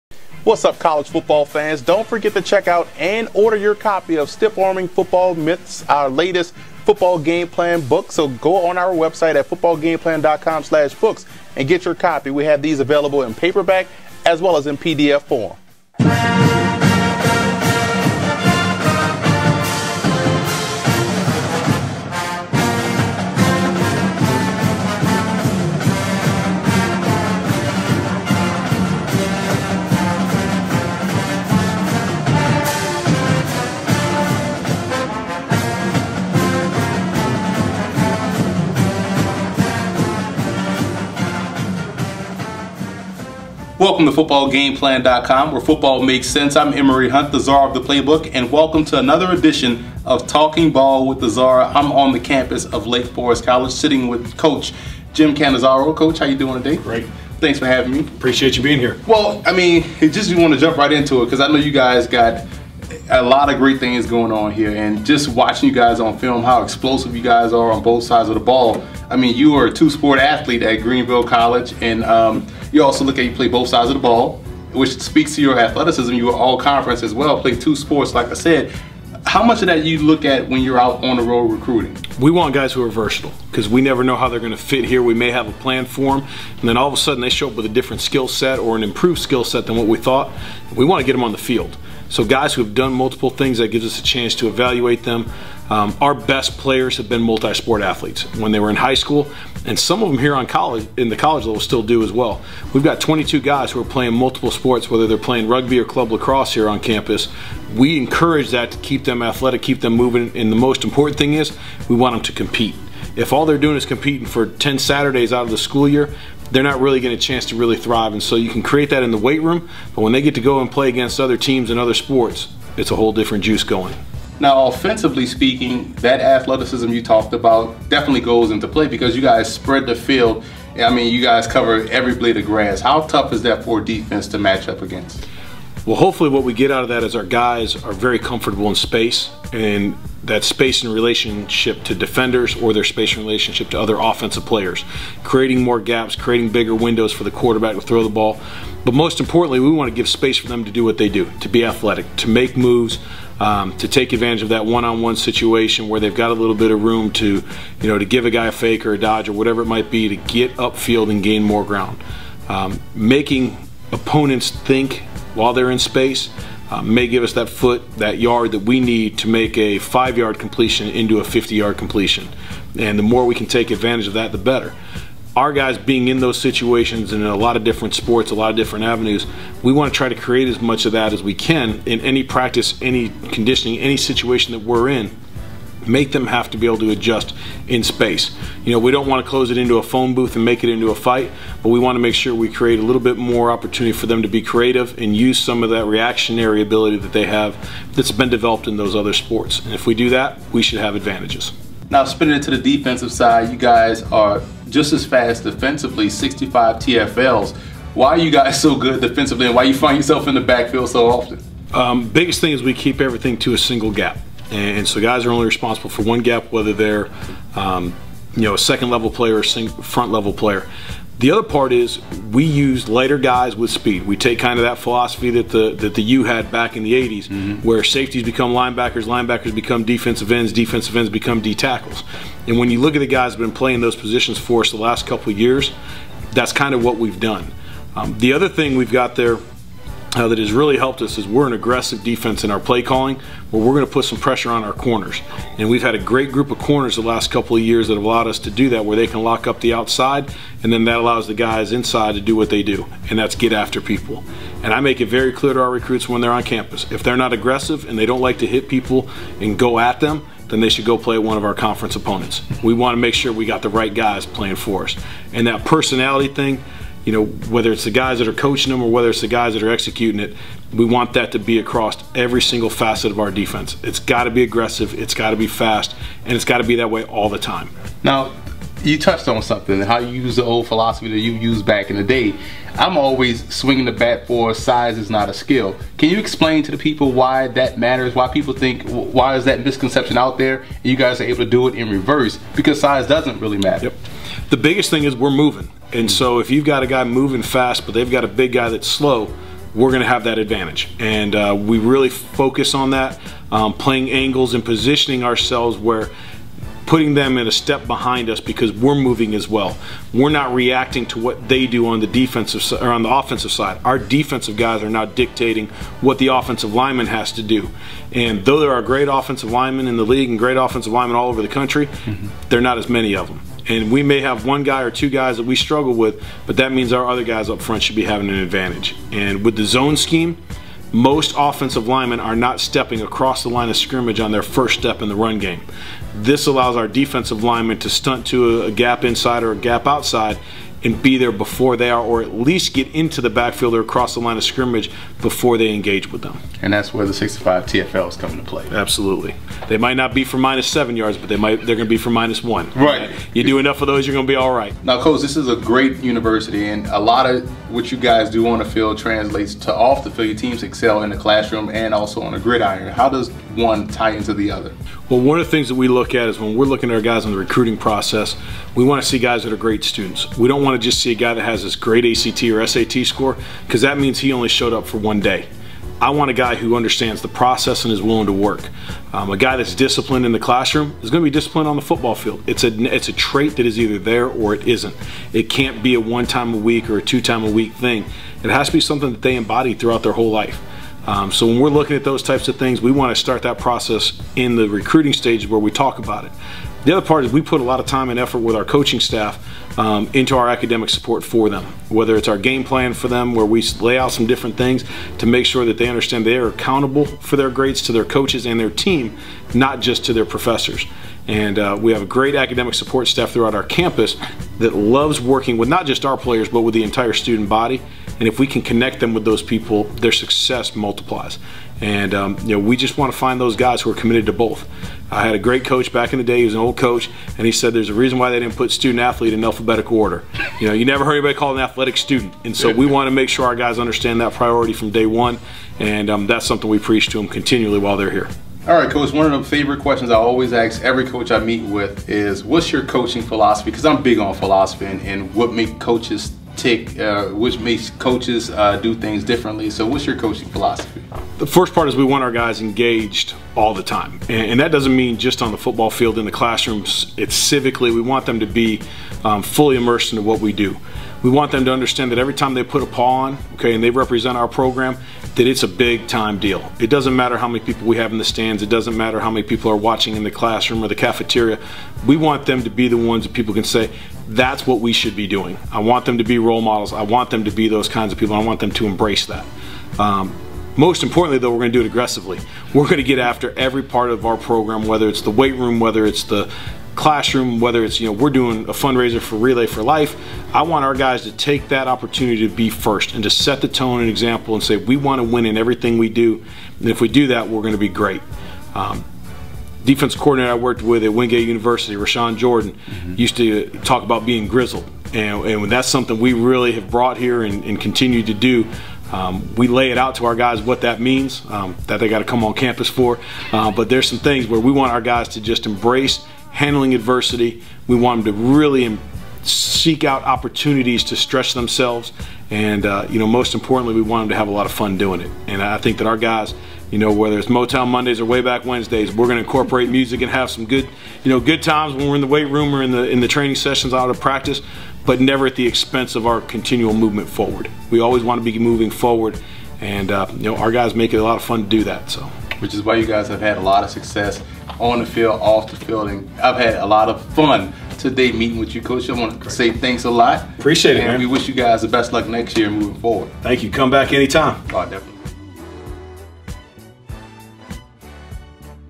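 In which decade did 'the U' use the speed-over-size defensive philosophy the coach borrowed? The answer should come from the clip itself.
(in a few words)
The 80s.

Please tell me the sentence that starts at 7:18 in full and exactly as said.
All right, coach, one of the favorite questions I always ask every coach I meet with is what's your coaching philosophy?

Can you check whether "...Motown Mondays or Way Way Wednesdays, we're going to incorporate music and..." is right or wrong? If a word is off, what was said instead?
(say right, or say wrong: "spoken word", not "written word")
wrong: "Back", not "Way".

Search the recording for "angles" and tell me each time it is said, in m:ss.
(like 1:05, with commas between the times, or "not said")
5:04.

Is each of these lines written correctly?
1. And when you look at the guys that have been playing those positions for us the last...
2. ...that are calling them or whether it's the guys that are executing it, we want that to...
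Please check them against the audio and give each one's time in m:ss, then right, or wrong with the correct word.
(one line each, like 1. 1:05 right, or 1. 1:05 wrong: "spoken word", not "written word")
1. 3:52 right
2. 4:28 wrong: "coaching", not "calling".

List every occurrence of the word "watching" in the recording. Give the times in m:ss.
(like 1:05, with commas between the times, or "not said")
1:05, 7:49.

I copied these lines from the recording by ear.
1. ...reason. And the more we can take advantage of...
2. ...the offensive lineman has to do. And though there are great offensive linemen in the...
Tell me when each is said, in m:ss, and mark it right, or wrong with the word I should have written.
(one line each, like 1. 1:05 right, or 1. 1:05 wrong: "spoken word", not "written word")
1. 2:51 wrong: "completion", not "reason"
2. 5:16 right.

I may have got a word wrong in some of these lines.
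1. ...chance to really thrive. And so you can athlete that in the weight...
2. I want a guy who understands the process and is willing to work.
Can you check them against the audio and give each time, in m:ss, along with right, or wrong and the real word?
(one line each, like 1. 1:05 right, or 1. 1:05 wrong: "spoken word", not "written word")
1. 1:57 wrong: "create", not "athlete"
2. 6:16 right.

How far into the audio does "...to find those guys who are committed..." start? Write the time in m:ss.
7:03.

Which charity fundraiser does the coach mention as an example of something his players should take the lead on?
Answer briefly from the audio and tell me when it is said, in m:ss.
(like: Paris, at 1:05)
Relay for Life, at 8:09.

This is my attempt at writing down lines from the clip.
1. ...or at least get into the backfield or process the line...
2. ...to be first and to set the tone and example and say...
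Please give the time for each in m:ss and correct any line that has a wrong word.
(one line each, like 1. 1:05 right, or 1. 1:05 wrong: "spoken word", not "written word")
1. 5:42 wrong: "across", not "process"
2. 8:12 right.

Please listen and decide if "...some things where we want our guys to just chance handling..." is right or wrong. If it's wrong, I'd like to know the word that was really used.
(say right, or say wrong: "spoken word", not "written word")
wrong: "embrace", not "chance".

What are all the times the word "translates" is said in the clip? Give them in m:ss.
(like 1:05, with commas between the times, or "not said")
5:58.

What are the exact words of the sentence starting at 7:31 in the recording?
The first part is we want our guys engaged all the time.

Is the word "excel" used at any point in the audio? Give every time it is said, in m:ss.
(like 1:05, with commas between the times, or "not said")
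6:00.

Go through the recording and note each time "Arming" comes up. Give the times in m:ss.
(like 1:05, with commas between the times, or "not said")
0:04.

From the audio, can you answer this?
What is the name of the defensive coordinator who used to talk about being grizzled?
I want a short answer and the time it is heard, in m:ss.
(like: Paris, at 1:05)
Rashawn Jordan, at 8:21.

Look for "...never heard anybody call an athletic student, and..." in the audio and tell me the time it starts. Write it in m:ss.
7:10.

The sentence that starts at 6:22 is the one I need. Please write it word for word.
It's a it's a trait that is either there or it isn't.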